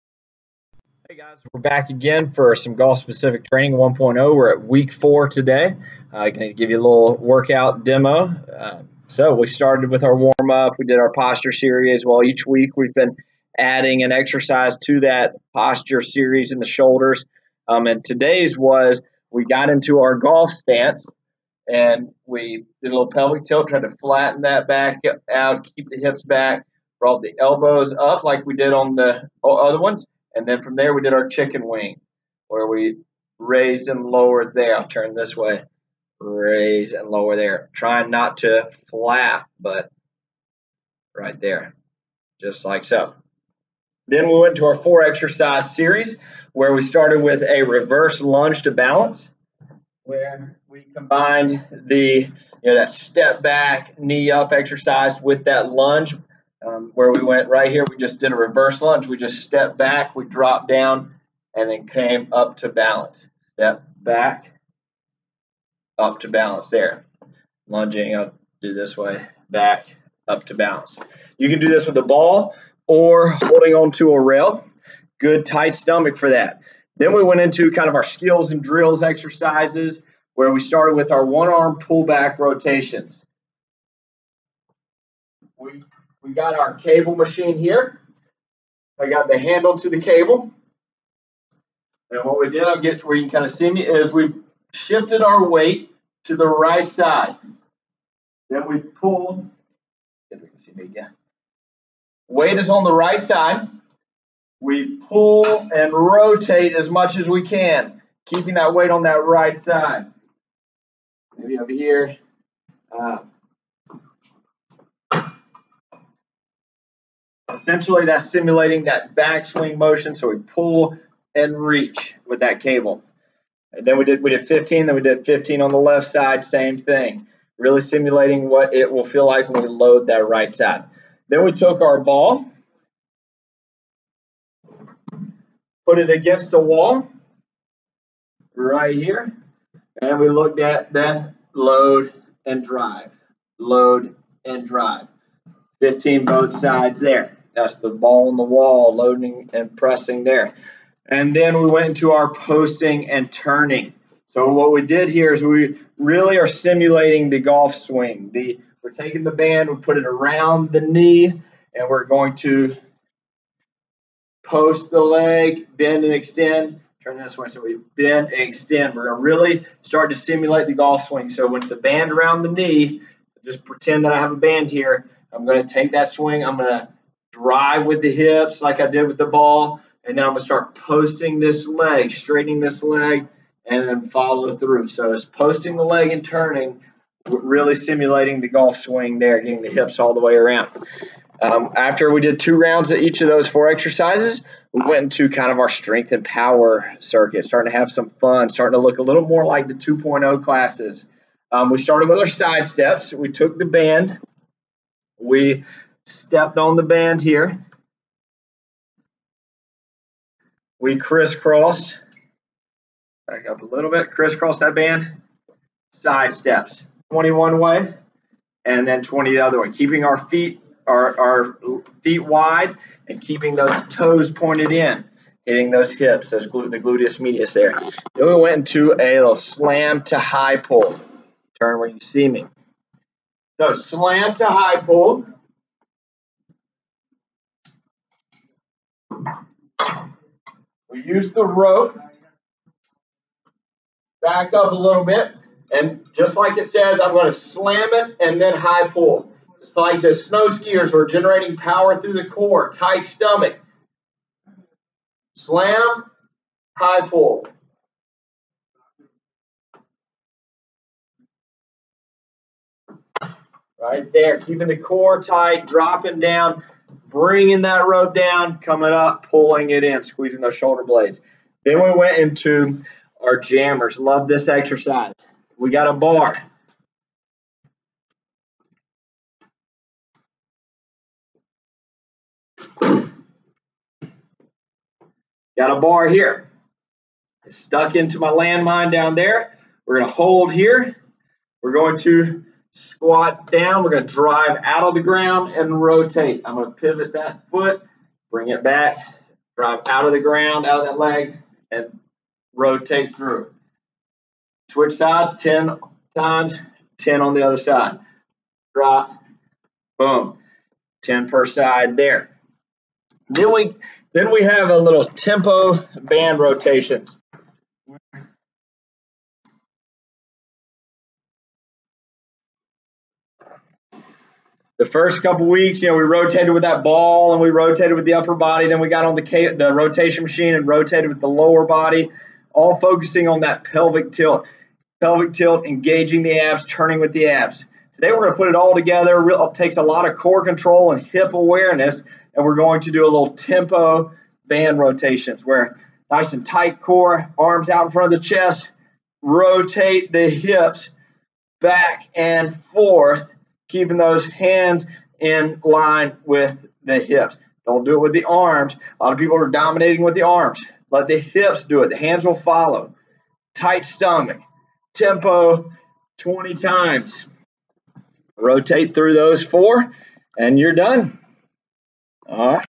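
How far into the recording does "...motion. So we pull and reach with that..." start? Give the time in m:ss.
1:59.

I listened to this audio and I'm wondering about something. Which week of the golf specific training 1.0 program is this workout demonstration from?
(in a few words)
4.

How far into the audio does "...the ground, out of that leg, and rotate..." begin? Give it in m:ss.
5:00.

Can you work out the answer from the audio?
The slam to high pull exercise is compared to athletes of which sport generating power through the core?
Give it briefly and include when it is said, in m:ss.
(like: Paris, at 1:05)
snow skiers, at 4:10.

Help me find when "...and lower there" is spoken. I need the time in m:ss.
0:36.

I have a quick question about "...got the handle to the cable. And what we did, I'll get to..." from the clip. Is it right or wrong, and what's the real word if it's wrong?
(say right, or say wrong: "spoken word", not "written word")
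right.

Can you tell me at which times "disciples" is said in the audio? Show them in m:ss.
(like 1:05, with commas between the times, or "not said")
not said.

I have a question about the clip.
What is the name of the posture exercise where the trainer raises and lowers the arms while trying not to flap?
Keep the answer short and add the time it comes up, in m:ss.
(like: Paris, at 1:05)
chicken wing, at 0:31.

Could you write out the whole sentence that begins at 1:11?
You can do this with a ball or holding onto a rail.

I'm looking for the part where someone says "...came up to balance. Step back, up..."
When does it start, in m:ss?
1:01.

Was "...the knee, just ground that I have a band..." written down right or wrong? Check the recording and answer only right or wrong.
wrong.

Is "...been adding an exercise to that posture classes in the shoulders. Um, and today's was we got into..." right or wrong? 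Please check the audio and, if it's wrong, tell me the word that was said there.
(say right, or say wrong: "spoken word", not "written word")
wrong: "series", not "classes".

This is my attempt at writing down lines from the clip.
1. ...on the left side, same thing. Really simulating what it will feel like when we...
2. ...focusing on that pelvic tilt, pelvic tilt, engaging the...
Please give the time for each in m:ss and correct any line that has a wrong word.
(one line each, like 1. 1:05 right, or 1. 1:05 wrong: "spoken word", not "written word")
1. 2:05 right
2. 5:32 right.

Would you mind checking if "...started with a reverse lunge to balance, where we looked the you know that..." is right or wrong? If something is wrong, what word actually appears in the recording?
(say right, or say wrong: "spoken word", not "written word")
wrong: "combined", not "looked".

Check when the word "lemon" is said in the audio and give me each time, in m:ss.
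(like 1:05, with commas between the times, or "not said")
not said.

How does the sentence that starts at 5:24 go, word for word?
the first couple weeks, you know, we rotated with that ball and we rotated with the upper body.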